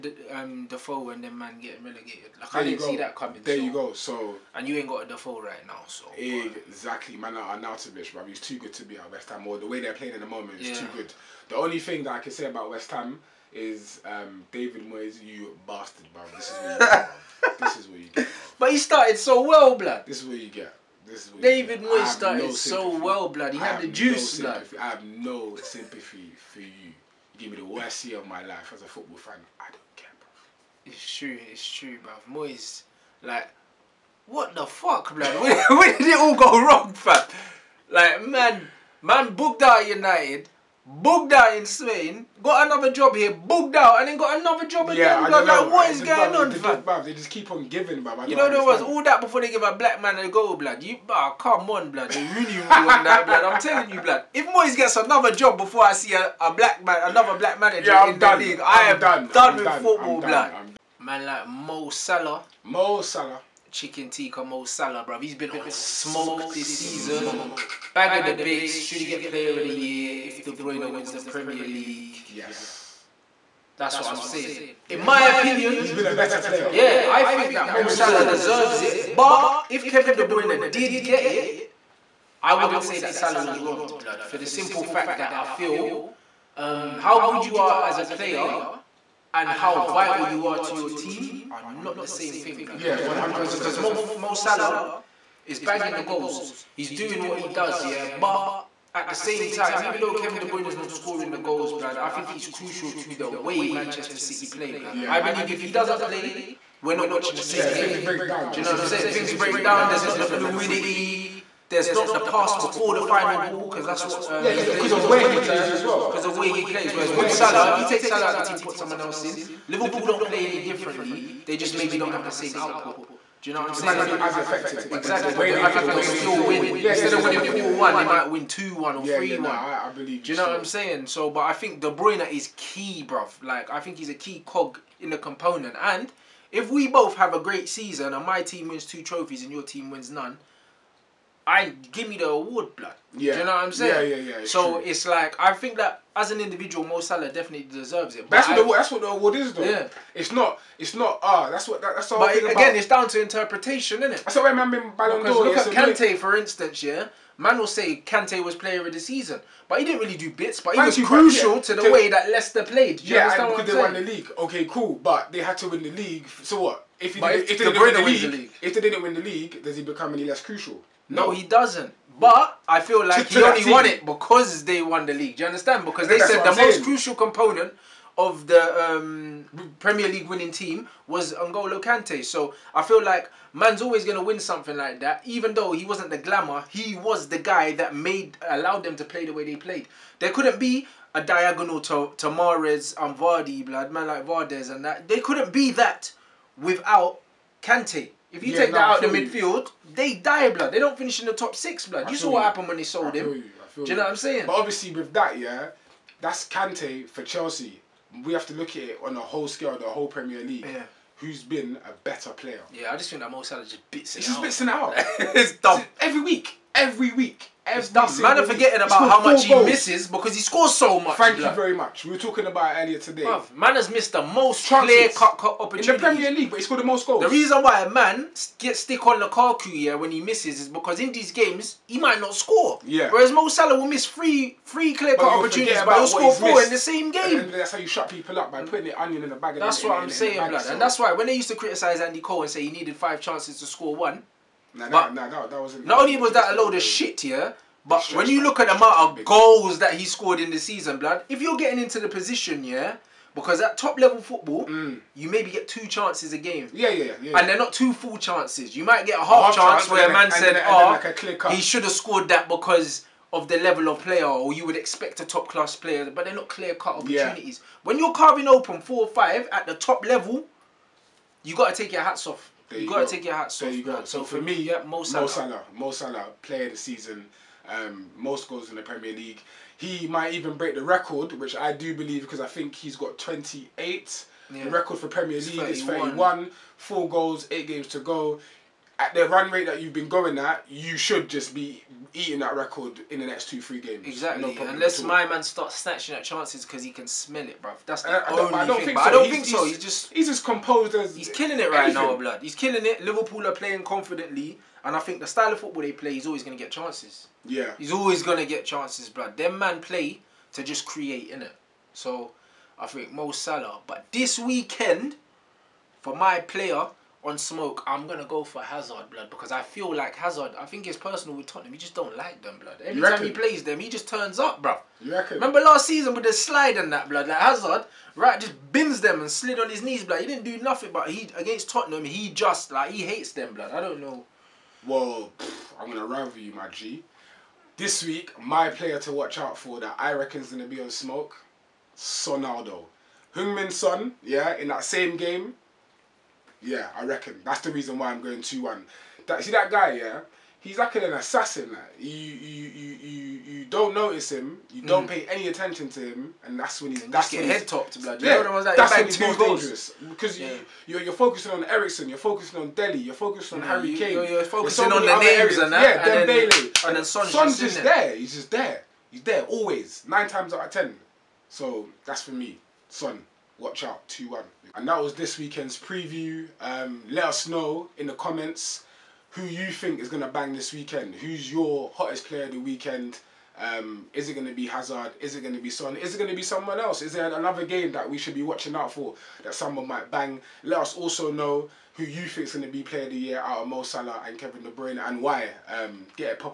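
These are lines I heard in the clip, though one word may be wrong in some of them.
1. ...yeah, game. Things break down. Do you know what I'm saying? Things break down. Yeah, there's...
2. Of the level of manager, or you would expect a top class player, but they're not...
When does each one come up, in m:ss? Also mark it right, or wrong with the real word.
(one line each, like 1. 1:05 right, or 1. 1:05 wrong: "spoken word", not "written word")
1. 1:47 right
2. 4:23 wrong: "player", not "manager".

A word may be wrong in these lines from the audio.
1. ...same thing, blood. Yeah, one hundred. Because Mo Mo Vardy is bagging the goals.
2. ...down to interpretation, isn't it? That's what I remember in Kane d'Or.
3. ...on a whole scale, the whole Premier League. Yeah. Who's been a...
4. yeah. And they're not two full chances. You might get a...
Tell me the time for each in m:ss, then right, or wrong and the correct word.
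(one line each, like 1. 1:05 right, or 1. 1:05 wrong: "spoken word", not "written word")
1. 1:32 wrong: "Salah", not "Vardy"
2. 2:32 wrong: "Ballon", not "Kane"
3. 3:29 right
4. 4:17 right.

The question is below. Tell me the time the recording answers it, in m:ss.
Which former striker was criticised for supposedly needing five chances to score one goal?
4:02.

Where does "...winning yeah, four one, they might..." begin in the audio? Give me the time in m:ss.
2:07.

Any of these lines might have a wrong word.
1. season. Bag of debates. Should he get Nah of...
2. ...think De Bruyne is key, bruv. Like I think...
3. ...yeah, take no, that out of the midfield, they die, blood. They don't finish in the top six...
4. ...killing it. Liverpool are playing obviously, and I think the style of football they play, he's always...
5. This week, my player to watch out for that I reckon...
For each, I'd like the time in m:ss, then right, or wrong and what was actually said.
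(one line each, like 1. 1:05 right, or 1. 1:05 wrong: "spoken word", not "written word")
1. 1:06 wrong: "Player", not "Nah"
2. 2:11 right
3. 3:18 right
4. 5:02 wrong: "confidently", not "obviously"
5. 5:37 right.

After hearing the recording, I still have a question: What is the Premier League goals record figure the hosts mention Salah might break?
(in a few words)
31.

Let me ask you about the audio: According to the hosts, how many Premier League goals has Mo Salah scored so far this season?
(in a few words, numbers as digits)
28.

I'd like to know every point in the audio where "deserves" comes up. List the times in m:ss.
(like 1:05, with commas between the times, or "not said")
1:18, 2:27.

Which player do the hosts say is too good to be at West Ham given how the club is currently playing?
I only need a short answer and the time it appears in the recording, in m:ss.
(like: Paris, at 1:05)
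Arnautovic, at 0:07.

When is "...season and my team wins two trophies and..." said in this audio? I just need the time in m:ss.
2:17.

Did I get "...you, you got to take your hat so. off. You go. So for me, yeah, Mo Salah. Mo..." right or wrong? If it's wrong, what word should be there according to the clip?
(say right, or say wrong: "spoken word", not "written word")
right.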